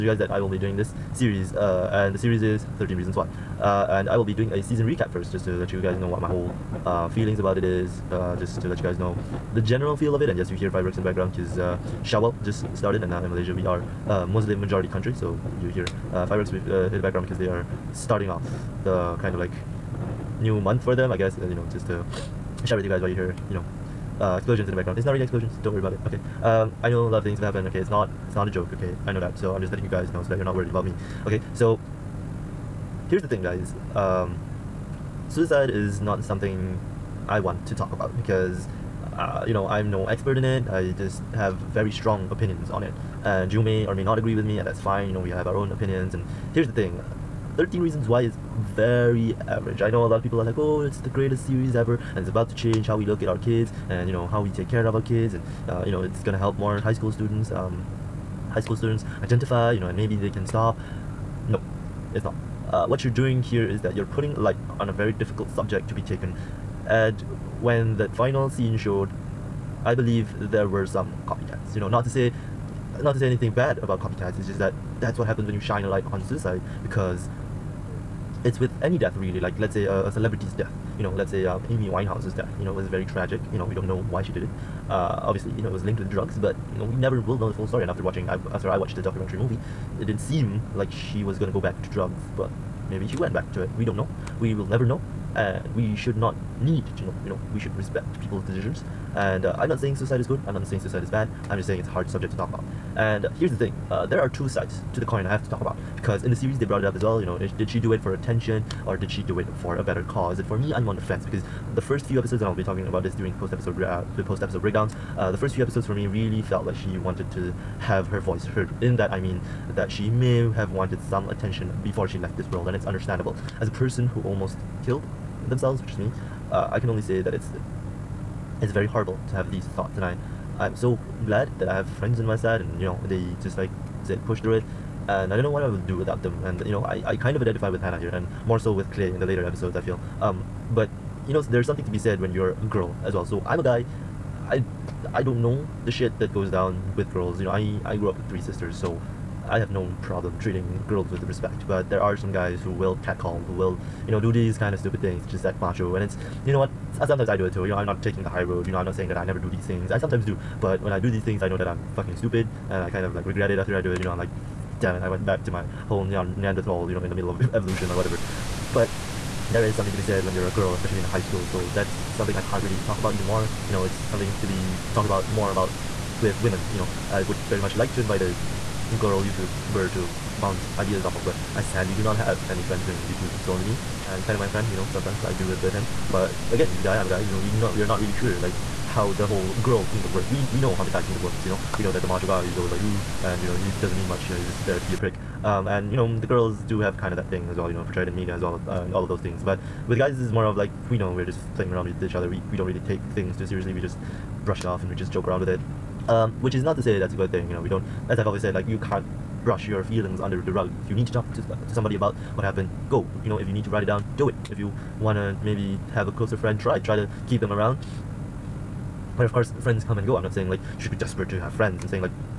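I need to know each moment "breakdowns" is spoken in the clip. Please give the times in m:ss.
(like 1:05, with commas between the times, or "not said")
1:54.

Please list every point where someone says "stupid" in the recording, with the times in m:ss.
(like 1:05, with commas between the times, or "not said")
2:34, 2:42.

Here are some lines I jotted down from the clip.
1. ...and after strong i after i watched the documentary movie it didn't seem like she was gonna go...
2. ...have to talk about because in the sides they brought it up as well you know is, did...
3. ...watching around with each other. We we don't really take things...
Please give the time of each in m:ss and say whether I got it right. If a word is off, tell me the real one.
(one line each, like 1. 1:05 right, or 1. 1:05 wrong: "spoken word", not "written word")
1. 1:27 wrong: "watching", not "strong"
2. 1:45 wrong: "series", not "sides"
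3. 3:21 wrong: "playing", not "watching".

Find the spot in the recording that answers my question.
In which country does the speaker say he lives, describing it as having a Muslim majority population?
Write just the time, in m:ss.
0:13.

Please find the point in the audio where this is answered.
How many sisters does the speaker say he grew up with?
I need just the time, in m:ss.
2:28.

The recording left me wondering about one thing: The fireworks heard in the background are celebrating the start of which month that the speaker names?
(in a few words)
Shawwal.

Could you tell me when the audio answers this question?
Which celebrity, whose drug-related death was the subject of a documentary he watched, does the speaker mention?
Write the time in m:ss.
1:21.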